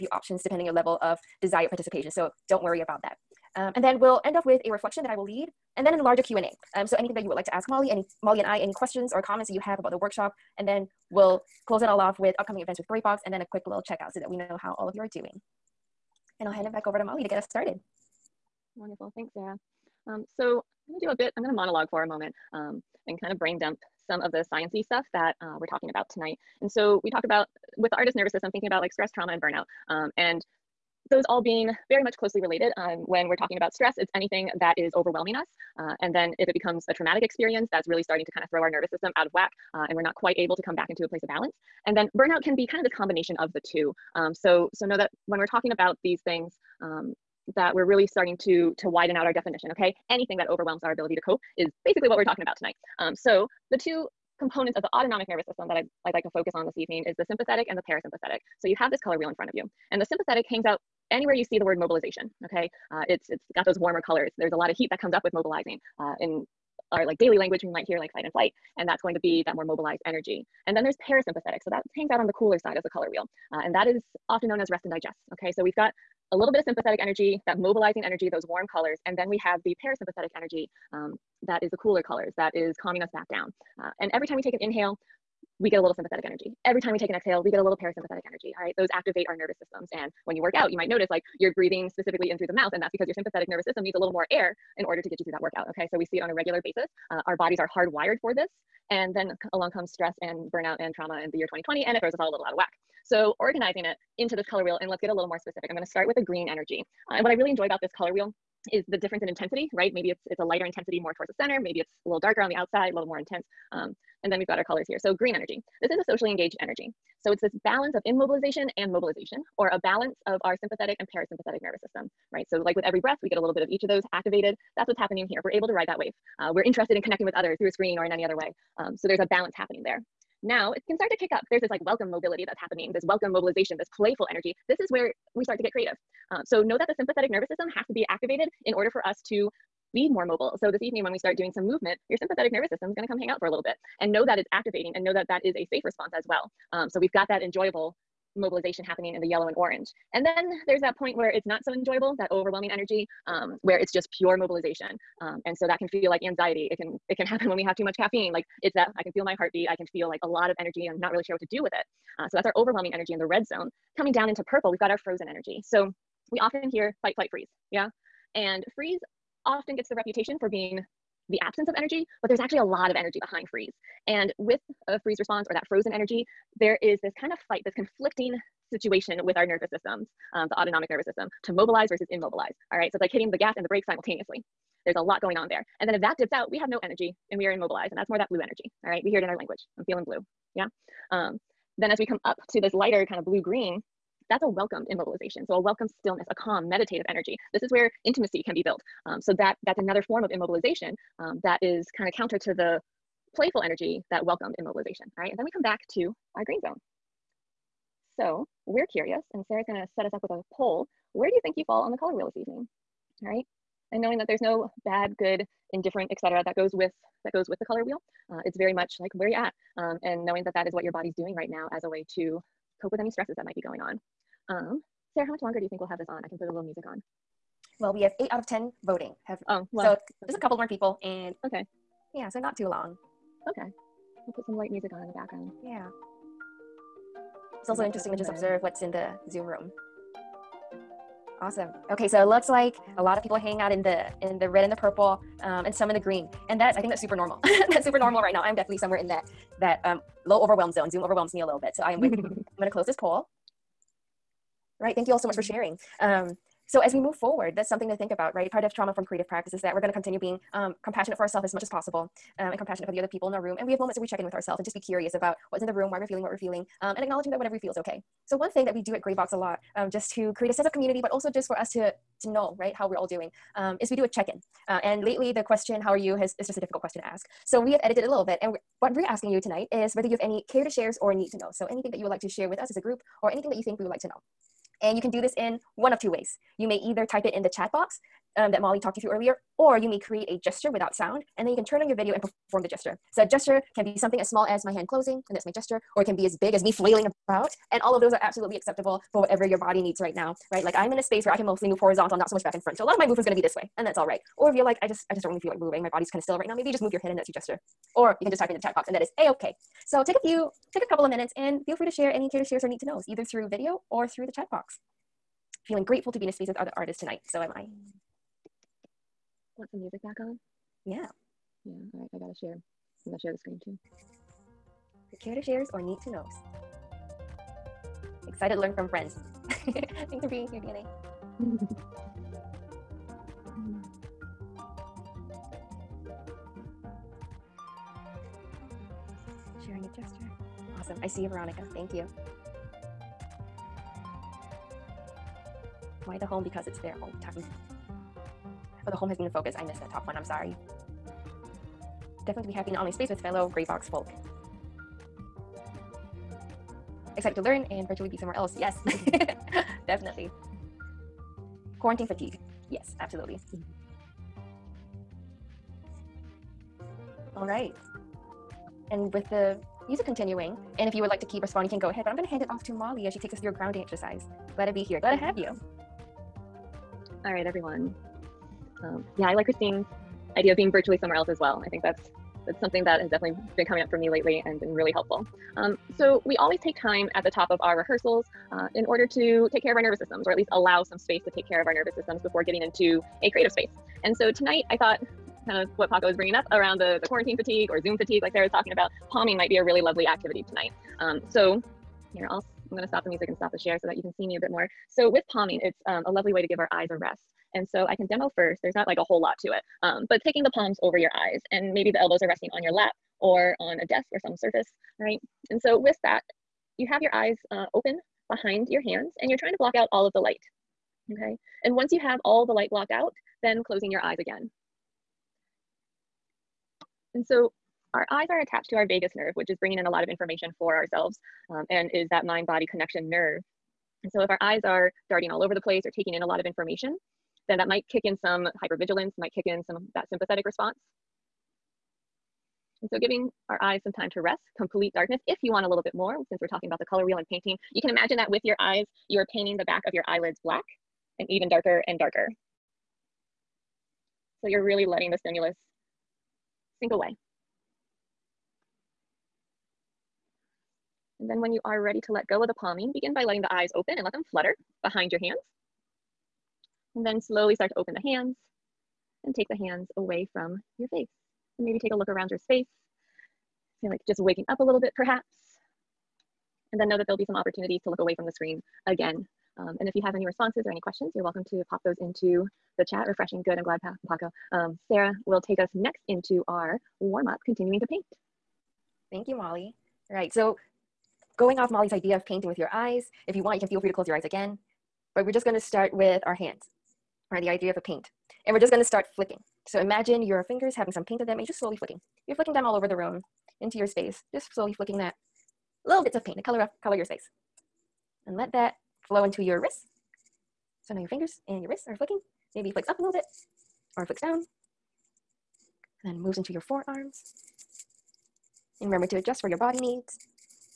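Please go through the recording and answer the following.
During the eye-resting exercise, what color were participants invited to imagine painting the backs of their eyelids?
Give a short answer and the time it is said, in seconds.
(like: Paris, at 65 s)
Black, at 450 s.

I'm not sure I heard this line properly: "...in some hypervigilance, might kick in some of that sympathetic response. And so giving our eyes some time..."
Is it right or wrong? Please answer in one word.
right.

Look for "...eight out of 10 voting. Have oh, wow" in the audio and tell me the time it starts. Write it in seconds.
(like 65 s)
228 s.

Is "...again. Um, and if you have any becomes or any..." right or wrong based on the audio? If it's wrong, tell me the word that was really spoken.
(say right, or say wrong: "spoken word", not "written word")
wrong: "responses", not "becomes".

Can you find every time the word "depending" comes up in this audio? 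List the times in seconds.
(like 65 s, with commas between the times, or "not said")
0 s.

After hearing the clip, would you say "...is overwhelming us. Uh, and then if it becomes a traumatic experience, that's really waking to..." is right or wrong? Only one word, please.
wrong.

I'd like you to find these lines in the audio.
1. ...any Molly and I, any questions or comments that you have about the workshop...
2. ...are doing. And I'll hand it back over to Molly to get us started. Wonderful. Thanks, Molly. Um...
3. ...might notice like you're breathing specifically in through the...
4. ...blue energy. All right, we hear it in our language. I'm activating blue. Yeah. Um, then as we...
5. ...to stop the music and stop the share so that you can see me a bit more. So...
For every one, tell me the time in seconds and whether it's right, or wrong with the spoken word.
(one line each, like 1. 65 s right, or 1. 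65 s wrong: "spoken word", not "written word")
1. 7 s right
2. 15 s wrong: "Sarah", not "Molly"
3. 90 s right
4. 188 s wrong: "feeling", not "activating"
5. 402 s right.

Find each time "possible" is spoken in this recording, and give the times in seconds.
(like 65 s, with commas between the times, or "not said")
261 s.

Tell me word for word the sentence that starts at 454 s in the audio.
So you're really letting the stimulus sink away.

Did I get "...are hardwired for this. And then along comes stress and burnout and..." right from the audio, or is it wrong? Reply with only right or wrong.
right.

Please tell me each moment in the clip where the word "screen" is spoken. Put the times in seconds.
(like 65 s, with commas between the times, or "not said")
127 s, 323 s, 478 s.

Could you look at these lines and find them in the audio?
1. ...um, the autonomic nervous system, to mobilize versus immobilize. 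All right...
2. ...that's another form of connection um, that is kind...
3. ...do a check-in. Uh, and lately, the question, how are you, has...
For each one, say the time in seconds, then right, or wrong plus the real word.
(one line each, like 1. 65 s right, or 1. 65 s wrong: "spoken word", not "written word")
1. 180 s right
2. 199 s wrong: "immobilization", not "connection"
3. 273 s right.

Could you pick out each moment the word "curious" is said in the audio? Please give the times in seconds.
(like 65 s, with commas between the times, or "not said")
208 s, 264 s.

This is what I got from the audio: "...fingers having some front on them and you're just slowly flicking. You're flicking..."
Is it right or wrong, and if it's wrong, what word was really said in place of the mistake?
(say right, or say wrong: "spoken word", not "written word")
wrong: "paint", not "front".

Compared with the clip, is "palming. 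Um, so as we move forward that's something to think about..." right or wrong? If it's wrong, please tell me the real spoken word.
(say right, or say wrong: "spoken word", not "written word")
wrong: "sharing", not "palming".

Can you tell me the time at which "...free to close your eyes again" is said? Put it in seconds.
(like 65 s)
493 s.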